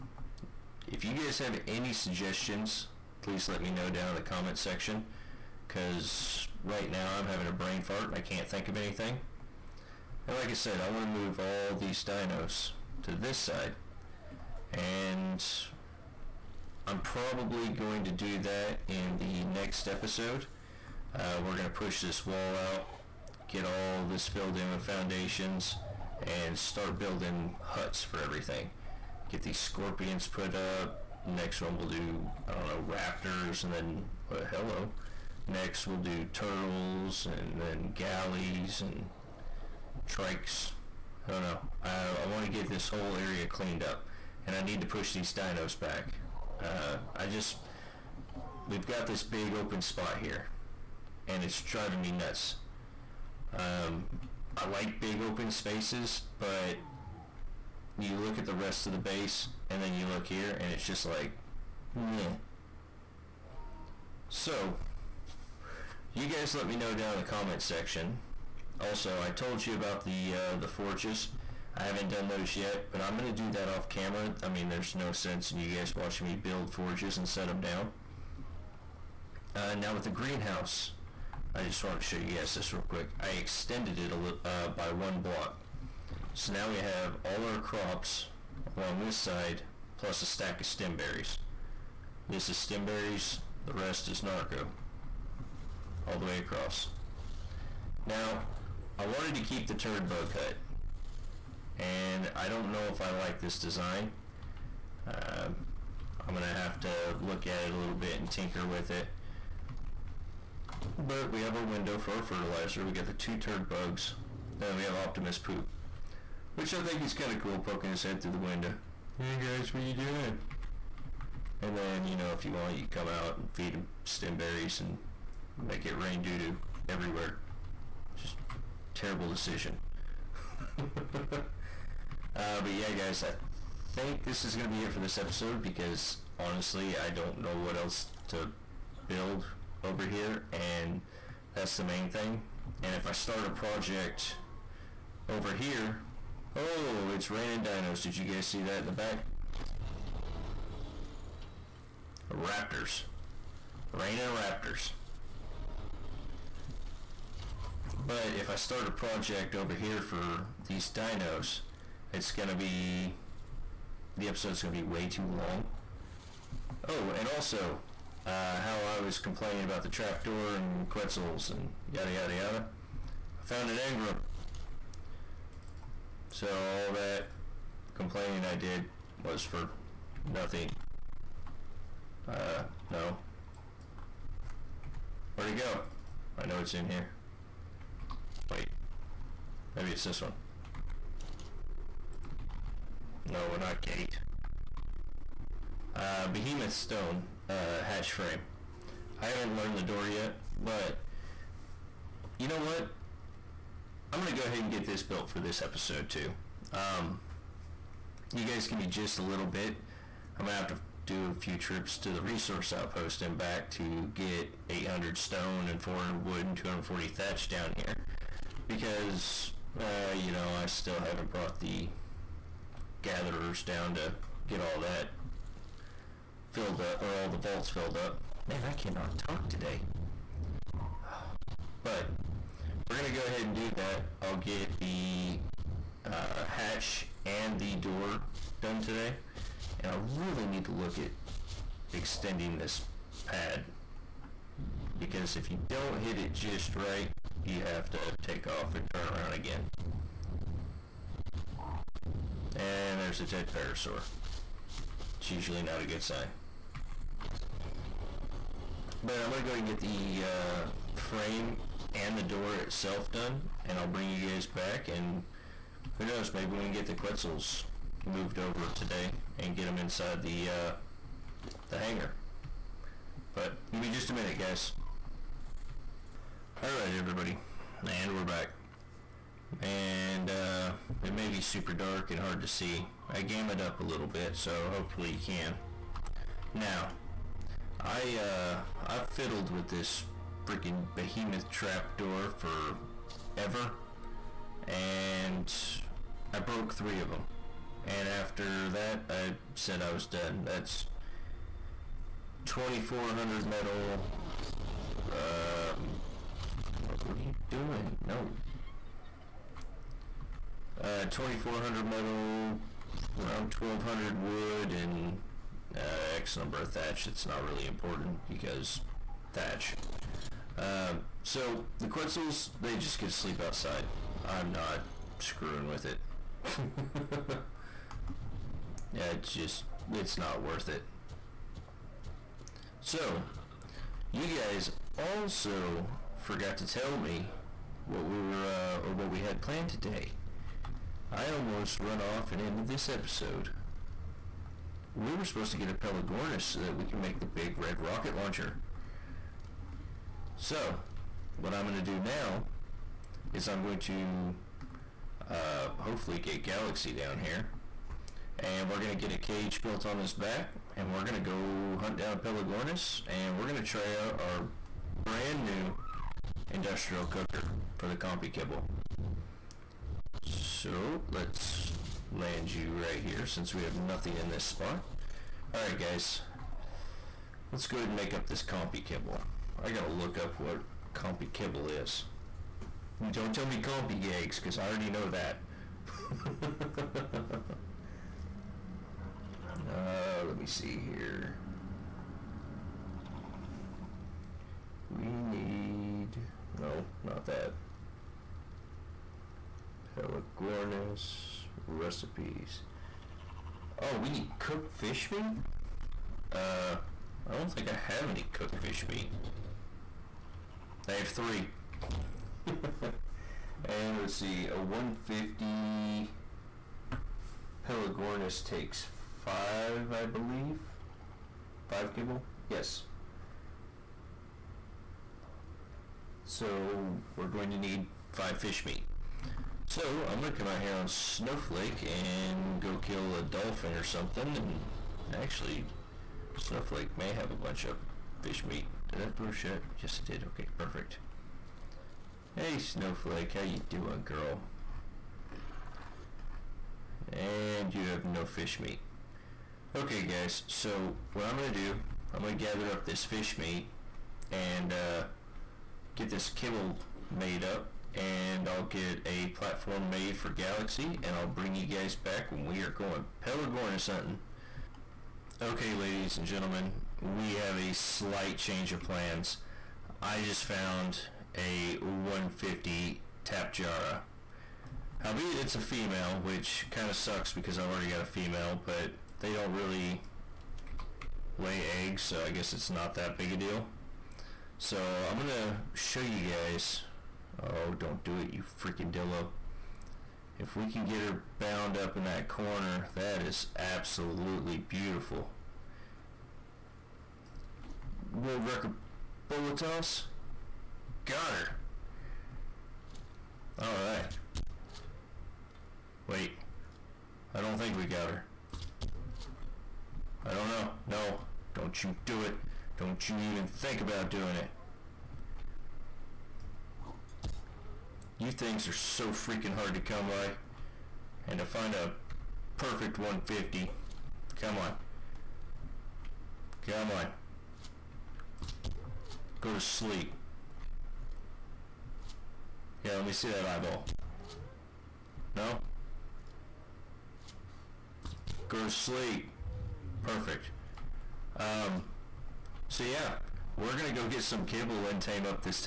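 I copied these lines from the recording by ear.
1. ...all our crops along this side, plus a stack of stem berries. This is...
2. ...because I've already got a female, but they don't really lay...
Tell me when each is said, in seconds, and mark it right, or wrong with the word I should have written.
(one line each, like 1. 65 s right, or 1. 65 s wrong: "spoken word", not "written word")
1. 87 s right
2. 477 s right.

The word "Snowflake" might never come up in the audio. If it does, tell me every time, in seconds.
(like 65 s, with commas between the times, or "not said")
430 s, 436 s, 442 s.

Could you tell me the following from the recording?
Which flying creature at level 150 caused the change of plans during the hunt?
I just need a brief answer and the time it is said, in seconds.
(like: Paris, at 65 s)
Tapejara, at 473 s.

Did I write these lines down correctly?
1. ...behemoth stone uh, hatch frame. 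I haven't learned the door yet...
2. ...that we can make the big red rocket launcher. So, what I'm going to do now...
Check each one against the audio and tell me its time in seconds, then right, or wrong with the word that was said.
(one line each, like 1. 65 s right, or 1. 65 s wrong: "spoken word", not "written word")
1. 196 s right
2. 346 s right.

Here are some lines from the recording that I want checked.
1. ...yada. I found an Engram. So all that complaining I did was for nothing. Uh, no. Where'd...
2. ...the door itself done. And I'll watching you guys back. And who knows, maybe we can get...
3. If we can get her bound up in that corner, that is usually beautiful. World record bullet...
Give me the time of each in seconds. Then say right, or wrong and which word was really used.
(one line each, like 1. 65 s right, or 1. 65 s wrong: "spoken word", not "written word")
1. 172 s right
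2. 262 s wrong: "bring", not "watching"
3. 490 s wrong: "absolutely", not "usually".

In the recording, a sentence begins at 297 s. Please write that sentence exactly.
And after that, I said I was done.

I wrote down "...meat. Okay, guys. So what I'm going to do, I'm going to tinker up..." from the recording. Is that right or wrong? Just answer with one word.
wrong.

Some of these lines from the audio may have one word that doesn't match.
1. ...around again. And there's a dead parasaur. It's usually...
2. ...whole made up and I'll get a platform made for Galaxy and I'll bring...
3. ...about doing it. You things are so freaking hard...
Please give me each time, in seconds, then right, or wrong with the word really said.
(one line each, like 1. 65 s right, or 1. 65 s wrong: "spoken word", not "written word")
1. 249 s right
2. 456 s wrong: "kibble", not "whole"
3. 513 s right.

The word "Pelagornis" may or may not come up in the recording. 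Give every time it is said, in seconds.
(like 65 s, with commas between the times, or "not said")
345 s, 362 s, 399 s, 417 s, 463 s.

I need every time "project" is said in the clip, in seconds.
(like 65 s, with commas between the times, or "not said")
143 s, 158 s.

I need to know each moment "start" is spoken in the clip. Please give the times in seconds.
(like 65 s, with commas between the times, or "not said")
26 s, 143 s, 158 s.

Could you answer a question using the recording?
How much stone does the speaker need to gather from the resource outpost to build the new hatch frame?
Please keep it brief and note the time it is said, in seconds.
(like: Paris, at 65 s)
800, at 214 s.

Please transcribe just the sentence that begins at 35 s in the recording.
Next we'll do turtles, and then galleys, and trikes.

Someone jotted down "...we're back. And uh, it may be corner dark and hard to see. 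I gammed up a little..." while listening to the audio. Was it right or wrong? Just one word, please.
wrong.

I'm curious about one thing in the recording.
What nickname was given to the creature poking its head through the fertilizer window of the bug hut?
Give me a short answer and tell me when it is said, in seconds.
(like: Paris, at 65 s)
Optimus Poop, at 114 s.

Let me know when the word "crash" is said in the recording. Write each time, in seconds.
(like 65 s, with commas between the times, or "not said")
not said.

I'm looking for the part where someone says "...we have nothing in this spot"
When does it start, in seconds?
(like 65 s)
373 s.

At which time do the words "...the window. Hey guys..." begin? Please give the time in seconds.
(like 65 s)
118 s.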